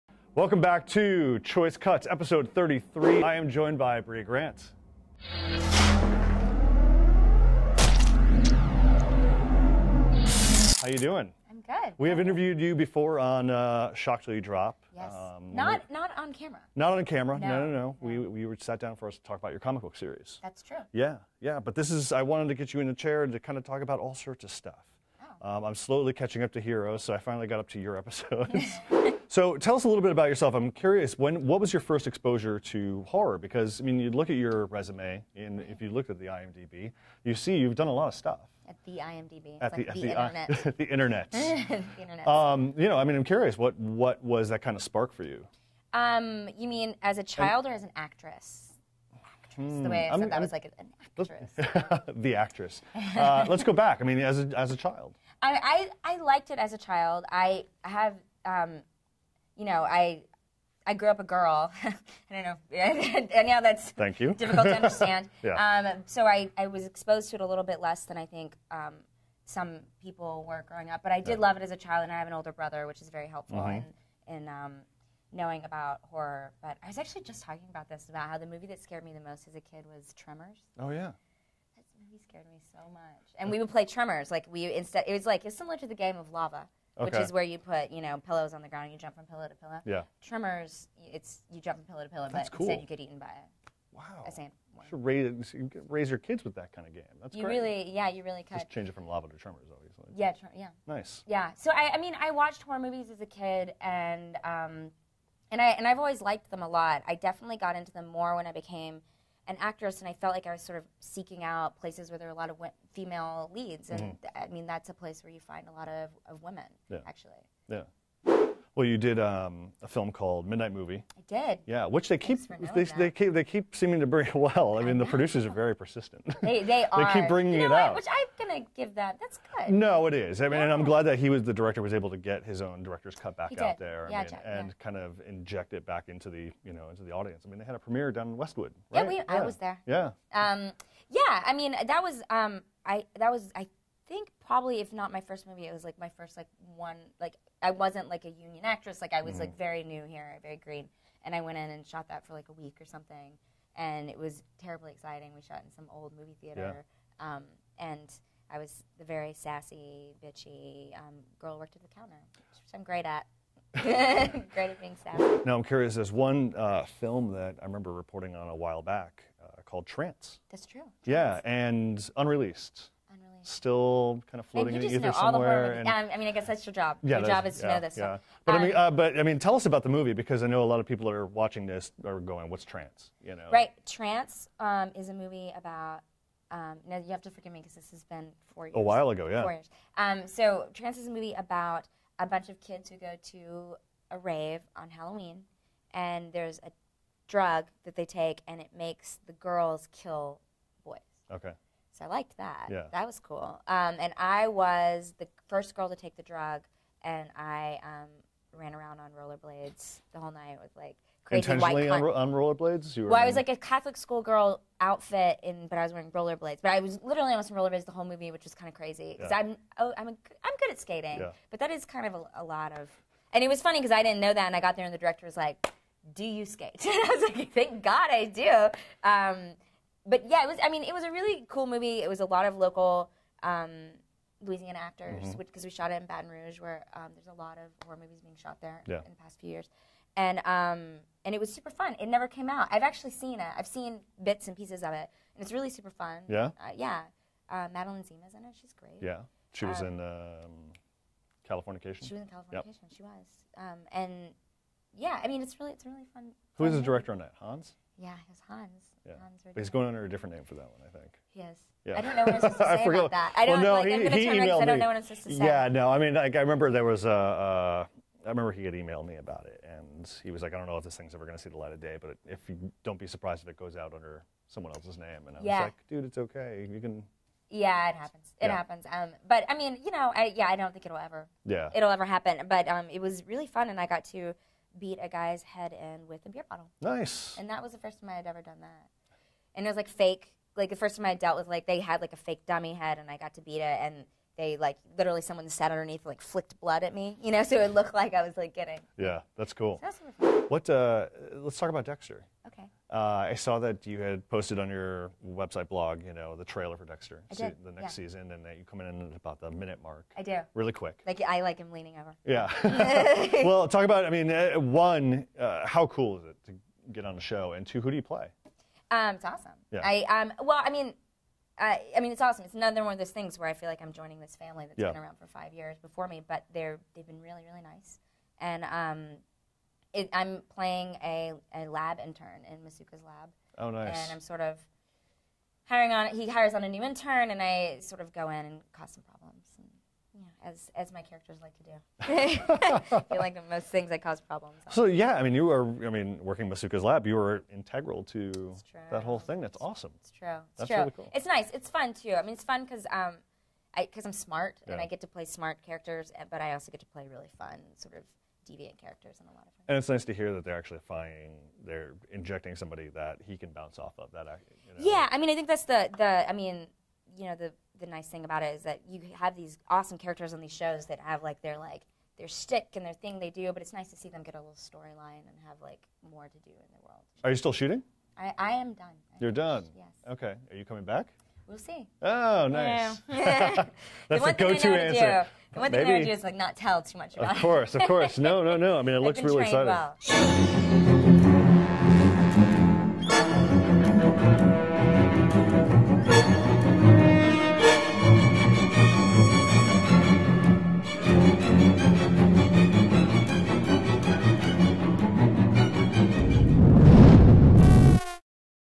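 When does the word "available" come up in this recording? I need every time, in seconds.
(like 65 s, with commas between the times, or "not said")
not said.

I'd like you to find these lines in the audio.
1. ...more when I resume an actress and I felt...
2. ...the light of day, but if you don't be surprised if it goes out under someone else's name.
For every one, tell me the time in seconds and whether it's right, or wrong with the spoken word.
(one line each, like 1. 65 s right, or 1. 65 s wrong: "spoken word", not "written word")
1. 108 s wrong: "became", not "resume"
2. 271 s right.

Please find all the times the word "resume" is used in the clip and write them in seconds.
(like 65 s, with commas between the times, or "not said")
34 s.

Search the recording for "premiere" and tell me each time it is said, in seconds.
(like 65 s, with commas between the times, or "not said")
137 s.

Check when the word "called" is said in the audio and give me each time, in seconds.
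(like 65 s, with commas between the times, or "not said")
120 s, 169 s.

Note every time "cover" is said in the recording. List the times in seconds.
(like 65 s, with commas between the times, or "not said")
not said.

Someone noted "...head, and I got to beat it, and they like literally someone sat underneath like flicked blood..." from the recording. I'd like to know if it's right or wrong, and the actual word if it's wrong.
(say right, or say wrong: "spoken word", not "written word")
right.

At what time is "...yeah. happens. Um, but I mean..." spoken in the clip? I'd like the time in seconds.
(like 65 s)
278 s.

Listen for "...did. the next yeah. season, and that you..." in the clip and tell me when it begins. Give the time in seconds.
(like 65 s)
307 s.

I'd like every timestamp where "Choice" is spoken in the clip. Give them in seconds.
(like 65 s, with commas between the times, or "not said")
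1 s.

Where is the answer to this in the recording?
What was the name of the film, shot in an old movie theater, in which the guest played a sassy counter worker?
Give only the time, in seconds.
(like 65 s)
120 s.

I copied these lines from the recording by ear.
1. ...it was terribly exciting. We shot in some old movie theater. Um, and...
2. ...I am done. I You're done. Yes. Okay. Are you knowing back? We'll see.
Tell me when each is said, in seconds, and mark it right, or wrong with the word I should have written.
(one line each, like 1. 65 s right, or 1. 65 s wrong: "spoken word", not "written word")
1. 154 s right
2. 378 s wrong: "coming", not "knowing".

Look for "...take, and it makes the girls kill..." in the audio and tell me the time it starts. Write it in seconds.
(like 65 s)
198 s.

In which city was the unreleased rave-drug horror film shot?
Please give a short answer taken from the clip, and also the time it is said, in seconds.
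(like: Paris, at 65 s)
Baton Rouge, at 236 s.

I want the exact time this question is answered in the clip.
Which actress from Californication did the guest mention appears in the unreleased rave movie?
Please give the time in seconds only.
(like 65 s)
247 s.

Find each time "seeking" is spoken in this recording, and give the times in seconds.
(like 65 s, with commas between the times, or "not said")
110 s.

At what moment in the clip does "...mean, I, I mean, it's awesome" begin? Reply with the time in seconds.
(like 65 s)
320 s.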